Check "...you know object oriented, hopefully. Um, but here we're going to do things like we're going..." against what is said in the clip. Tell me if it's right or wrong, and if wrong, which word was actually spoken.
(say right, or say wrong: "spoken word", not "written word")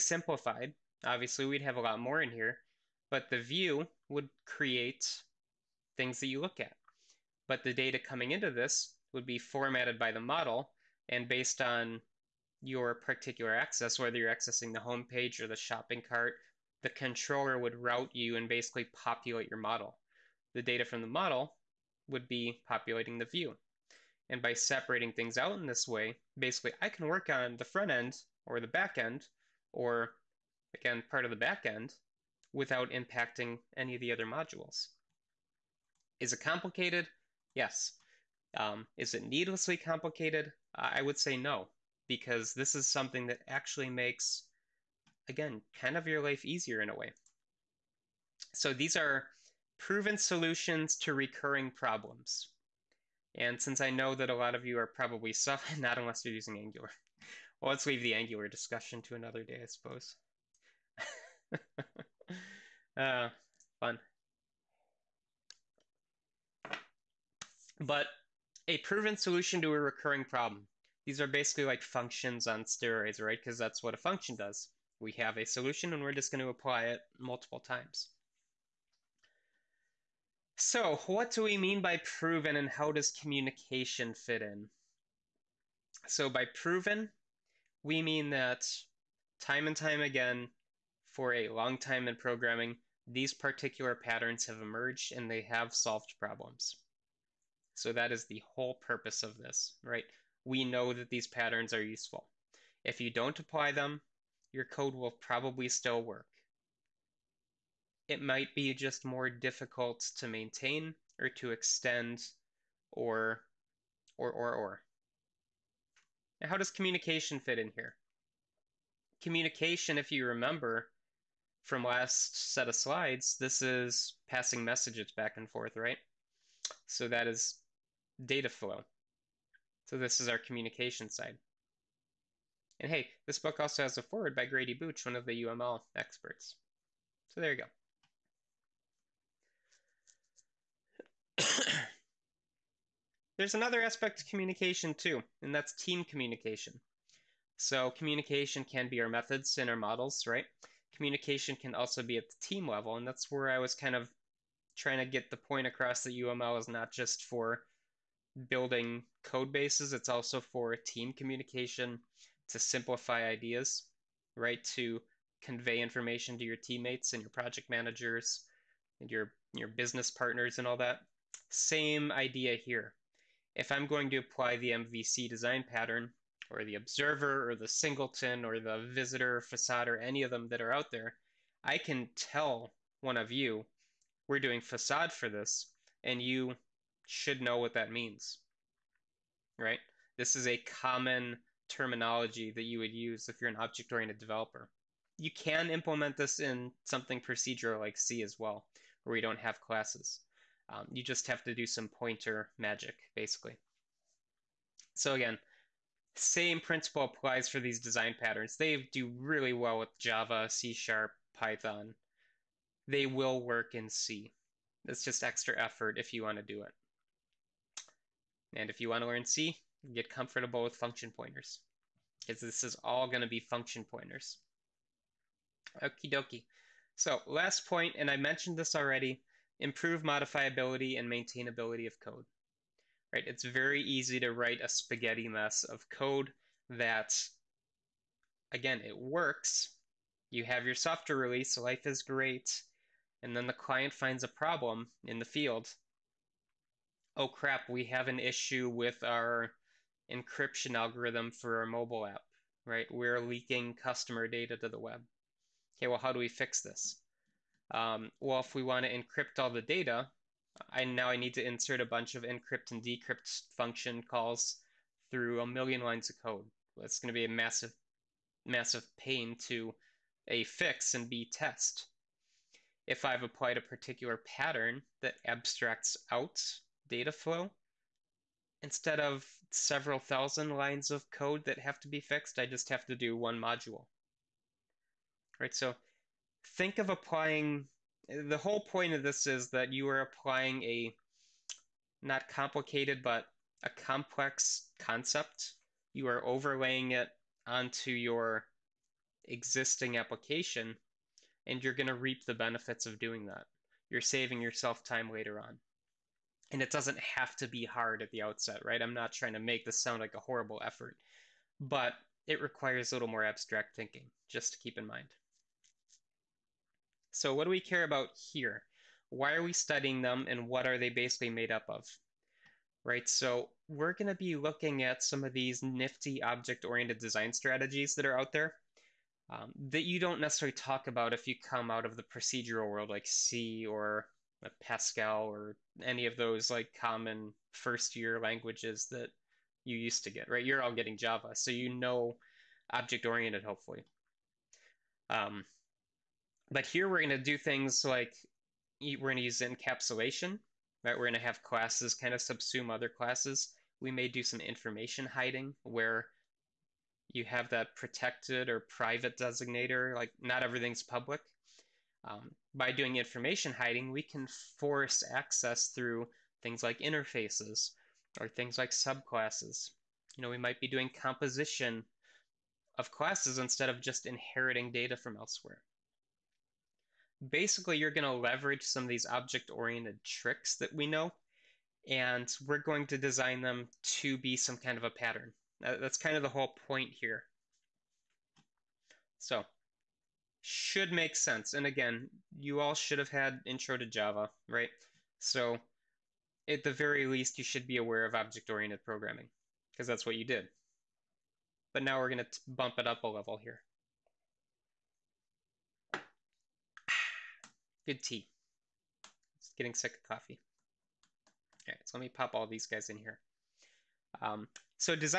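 right.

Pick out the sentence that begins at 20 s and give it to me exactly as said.
The data from the model would be populating the view.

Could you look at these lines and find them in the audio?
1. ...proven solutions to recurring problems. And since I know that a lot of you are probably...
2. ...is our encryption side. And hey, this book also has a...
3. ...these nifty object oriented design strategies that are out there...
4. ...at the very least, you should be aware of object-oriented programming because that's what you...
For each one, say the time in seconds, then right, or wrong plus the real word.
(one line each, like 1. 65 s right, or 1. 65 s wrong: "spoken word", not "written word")
1. 49 s right
2. 130 s wrong: "communication", not "encryption"
3. 325 s right
4. 396 s right.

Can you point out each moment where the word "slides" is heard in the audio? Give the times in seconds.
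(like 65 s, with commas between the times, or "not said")
122 s.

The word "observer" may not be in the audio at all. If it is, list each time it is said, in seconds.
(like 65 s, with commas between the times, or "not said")
176 s.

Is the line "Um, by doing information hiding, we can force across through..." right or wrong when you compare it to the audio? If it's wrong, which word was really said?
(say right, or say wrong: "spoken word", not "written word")
wrong: "access", not "across".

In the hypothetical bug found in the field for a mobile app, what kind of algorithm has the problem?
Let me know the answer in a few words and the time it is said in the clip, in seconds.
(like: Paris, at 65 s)
encryption algorithm, at 250 s.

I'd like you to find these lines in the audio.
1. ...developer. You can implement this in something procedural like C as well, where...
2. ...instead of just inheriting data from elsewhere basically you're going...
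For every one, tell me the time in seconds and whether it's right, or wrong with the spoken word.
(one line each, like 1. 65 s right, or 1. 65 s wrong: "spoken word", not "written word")
1. 194 s right
2. 373 s right.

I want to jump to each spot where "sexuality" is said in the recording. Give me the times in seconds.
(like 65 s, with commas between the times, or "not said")
not said.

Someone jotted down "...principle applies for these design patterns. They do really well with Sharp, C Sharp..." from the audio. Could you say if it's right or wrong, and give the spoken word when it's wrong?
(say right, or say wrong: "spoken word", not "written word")
wrong: "Java", not "Sharp".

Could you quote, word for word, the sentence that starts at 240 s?
You have your software release, life is great, and then the client finds a problem in the field.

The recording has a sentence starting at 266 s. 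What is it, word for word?
That's going to be a massive, massive pain to a fix and b test.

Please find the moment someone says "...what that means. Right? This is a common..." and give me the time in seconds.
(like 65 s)
187 s.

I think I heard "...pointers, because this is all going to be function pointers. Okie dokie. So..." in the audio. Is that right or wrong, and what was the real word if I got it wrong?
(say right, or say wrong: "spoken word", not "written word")
right.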